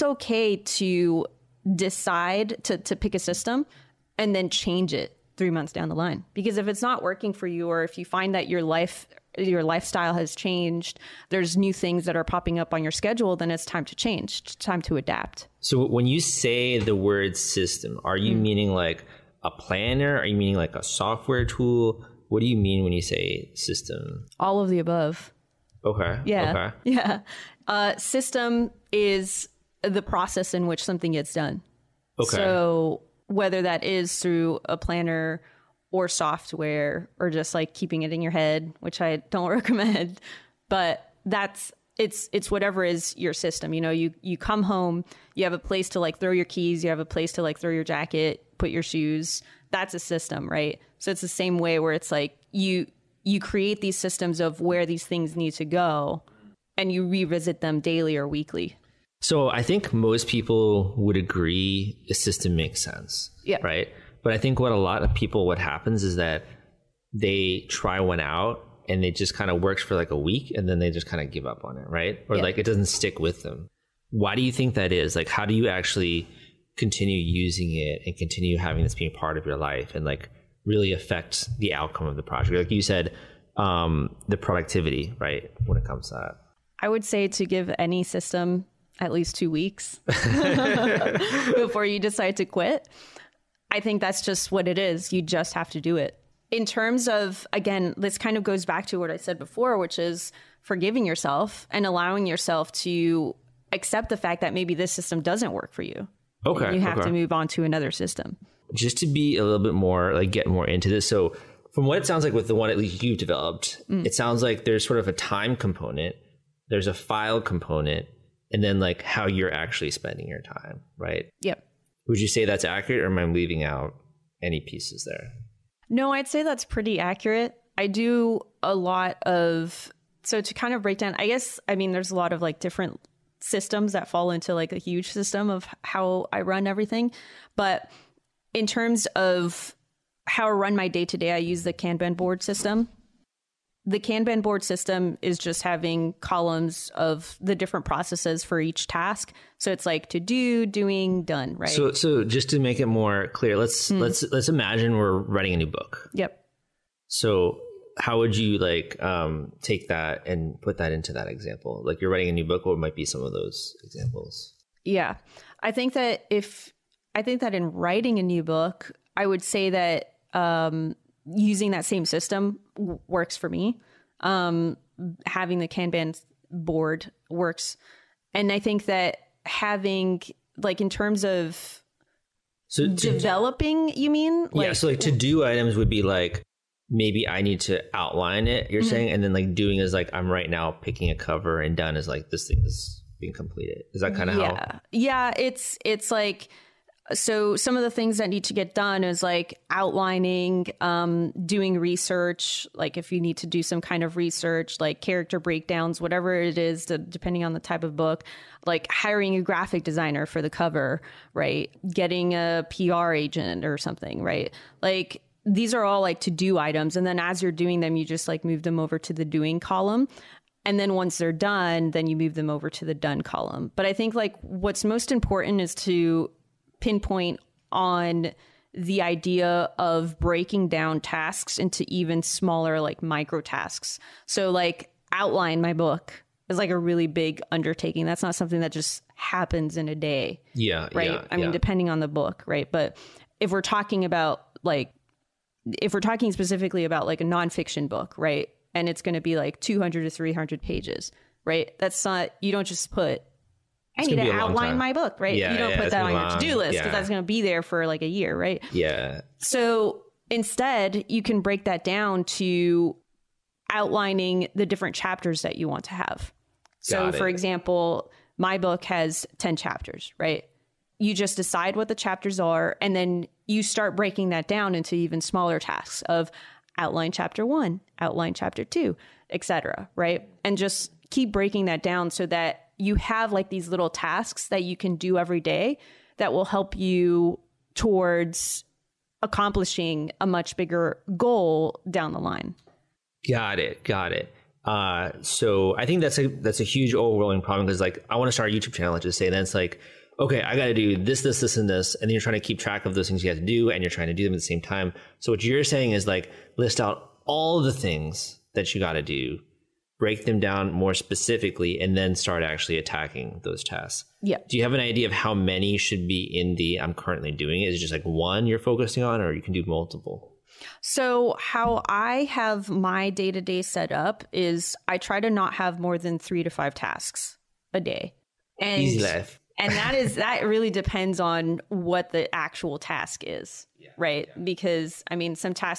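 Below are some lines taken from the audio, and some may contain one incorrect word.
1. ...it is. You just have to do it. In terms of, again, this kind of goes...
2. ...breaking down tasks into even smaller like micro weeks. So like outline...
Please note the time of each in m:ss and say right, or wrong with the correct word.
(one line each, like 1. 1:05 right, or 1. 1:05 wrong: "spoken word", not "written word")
1. 1:34 right
2. 3:50 wrong: "tasks", not "weeks".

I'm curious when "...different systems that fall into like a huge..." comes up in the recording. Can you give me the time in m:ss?
2:12.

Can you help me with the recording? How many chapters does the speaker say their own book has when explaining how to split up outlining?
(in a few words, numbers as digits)
10.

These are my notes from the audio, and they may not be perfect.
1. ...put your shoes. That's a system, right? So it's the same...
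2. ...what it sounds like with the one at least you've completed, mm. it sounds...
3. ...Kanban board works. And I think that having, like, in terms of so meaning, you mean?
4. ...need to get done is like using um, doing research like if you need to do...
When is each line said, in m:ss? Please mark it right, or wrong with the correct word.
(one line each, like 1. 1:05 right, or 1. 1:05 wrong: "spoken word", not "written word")
1. 0:48 right
2. 1:51 wrong: "developed", not "completed"
3. 2:55 wrong: "developing", not "meaning"
4. 3:18 wrong: "outlining", not "using".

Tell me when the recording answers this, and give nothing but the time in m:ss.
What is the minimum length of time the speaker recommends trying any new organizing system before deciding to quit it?
1:29.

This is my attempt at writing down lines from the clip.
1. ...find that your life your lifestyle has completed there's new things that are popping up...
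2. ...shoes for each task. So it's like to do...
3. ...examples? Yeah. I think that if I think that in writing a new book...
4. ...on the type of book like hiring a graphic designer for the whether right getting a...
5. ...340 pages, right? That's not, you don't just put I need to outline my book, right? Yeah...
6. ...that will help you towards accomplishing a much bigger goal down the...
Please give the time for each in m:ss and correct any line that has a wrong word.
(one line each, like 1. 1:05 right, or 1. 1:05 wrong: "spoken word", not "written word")
1. 0:08 wrong: "changed", not "completed"
2. 2:27 wrong: "processes", not "shoes"
3. 2:43 right
4. 3:27 wrong: "cover", not "whether"
5. 4:10 wrong: "300", not "340"
6. 4:46 right.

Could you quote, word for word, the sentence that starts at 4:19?
So instead, you can break that down to outlining the different chapters that you want to have.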